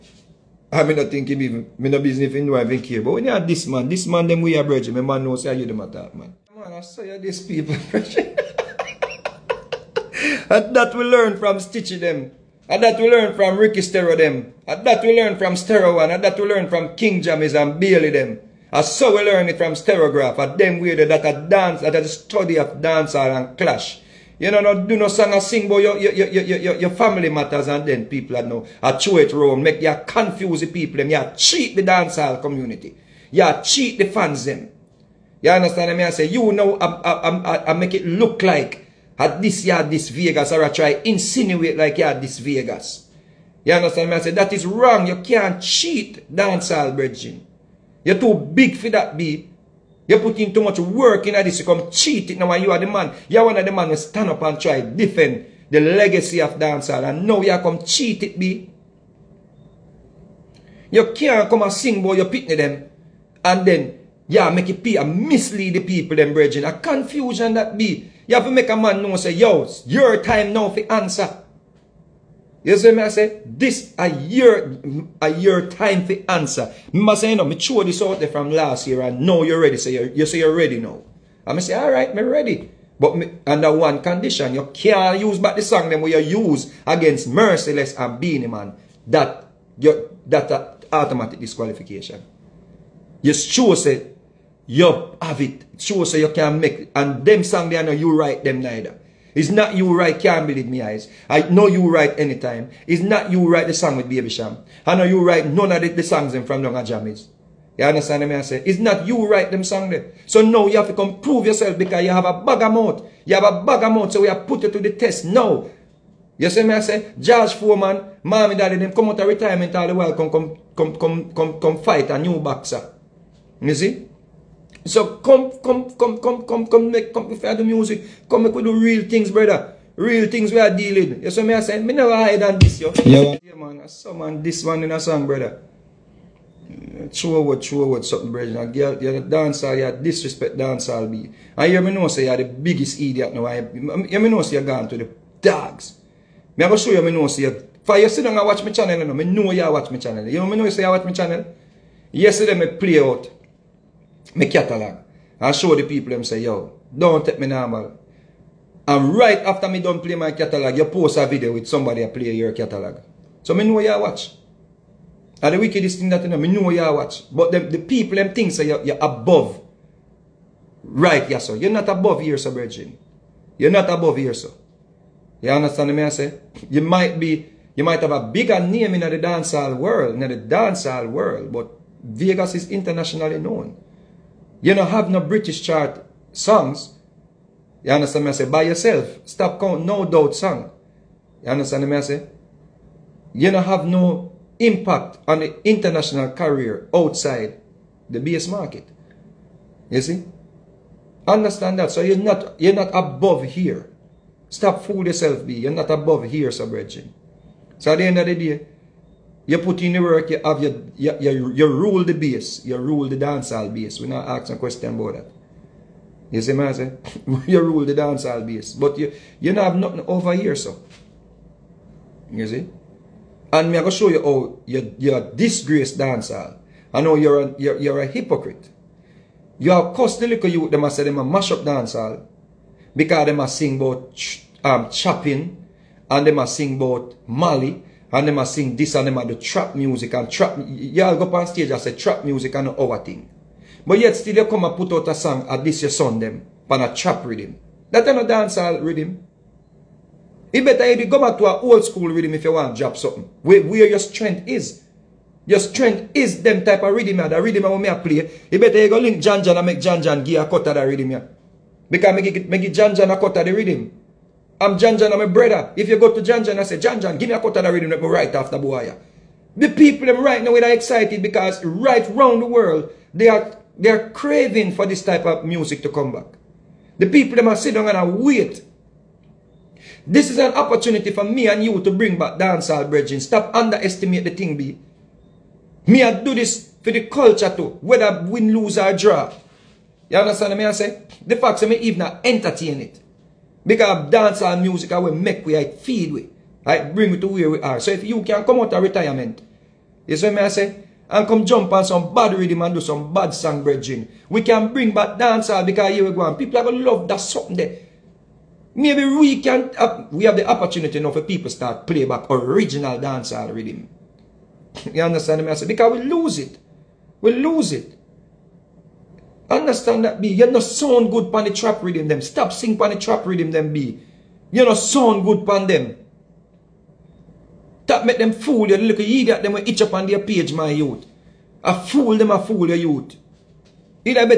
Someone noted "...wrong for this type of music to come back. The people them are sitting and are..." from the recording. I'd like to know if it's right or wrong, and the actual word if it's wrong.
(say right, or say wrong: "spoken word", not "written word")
wrong: "craving", not "wrong".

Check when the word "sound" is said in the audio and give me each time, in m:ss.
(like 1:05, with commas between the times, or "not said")
5:20, 5:24.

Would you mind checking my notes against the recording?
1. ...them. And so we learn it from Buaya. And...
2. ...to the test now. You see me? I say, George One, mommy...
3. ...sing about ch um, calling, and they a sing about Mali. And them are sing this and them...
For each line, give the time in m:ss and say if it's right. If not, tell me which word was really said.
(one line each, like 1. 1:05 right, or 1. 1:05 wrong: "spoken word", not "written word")
1. 0:18 wrong: "Stereograph", not "Buaya"
2. 1:54 wrong: "Foreman", not "One"
3. 3:53 wrong: "chopping", not "calling".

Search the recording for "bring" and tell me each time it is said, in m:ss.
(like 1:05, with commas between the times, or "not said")
4:41, 4:56, 5:04.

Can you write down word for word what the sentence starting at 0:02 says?
But when you are this man, this man them we are bridging, my man knows how you them attack, man.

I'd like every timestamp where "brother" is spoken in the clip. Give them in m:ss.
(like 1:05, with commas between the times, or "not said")
2:09, 2:15, 4:25.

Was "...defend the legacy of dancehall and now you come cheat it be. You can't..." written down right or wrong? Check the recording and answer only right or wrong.
right.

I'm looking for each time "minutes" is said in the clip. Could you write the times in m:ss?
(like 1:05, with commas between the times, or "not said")
not said.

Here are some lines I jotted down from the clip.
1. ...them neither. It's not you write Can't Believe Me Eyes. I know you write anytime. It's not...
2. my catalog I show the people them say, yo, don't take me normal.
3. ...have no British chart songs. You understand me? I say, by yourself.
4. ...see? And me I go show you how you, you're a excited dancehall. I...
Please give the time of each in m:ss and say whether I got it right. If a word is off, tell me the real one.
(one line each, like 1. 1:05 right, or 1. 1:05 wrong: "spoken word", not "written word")
1. 1:38 right
2. 2:34 right
3. 3:04 right
4. 3:42 wrong: "disgraced", not "excited".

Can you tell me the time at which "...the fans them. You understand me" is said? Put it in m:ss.
0:33.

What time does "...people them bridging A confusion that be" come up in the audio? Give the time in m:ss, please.
1:05.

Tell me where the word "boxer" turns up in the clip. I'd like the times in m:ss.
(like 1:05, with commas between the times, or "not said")
2:02.